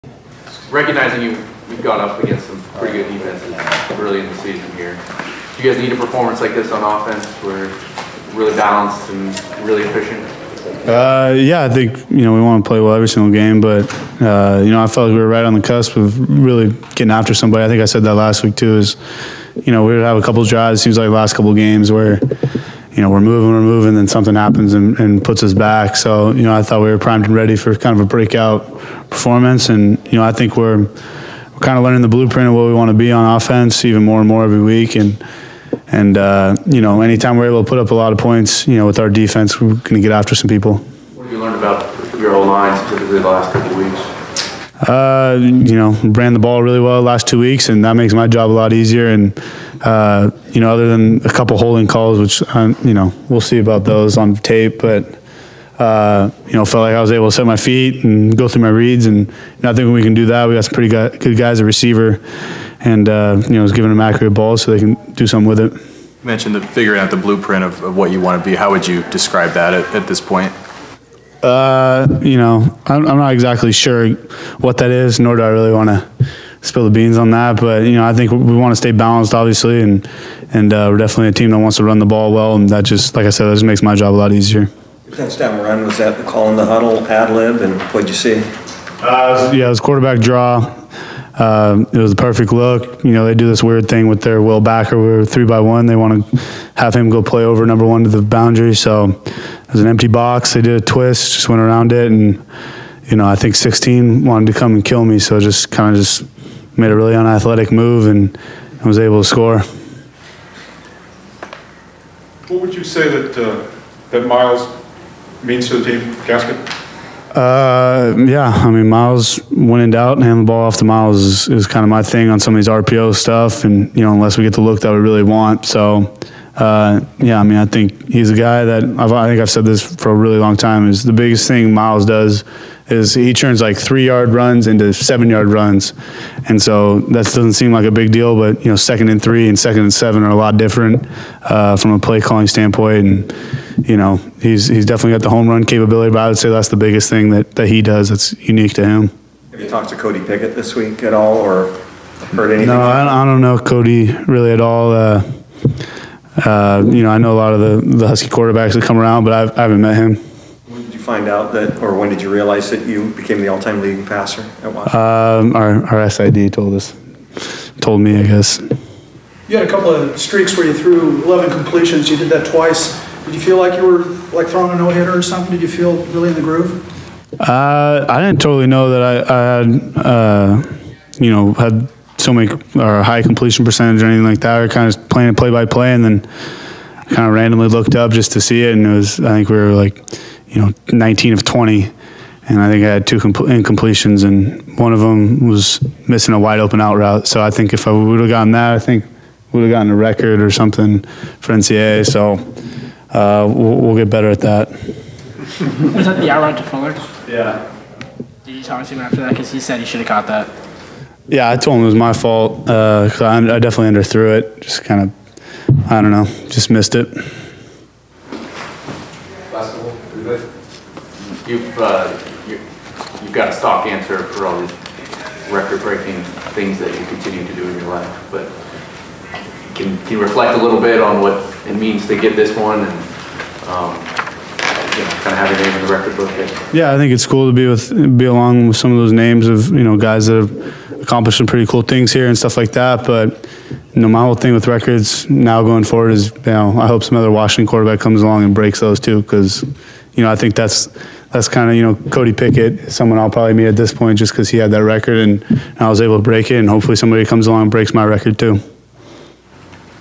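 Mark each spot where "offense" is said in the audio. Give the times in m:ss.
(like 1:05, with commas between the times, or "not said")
0:06, 0:33.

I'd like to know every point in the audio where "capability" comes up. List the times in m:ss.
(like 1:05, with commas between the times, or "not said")
2:25.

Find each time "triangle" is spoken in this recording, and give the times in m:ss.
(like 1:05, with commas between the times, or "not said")
not said.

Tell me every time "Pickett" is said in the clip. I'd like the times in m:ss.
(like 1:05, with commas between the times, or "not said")
2:30, 4:12.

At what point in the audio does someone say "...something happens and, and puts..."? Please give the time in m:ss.
0:24.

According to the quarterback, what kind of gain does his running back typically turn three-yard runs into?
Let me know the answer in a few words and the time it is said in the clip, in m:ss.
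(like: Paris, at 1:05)
7-yard runs, at 2:14.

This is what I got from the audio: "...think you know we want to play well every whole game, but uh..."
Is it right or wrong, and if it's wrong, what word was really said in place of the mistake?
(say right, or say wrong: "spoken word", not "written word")
wrong: "single", not "whole".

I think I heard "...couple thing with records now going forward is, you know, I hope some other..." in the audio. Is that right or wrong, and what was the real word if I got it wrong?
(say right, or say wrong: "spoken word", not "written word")
wrong: "whole", not "couple".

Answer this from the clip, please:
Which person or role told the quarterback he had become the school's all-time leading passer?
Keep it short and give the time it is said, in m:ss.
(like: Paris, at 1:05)
SID, at 2:46.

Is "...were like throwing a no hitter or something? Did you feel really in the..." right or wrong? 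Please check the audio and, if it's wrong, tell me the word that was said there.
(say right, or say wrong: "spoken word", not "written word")
right.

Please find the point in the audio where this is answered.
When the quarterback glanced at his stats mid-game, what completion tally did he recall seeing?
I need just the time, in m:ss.
3:10.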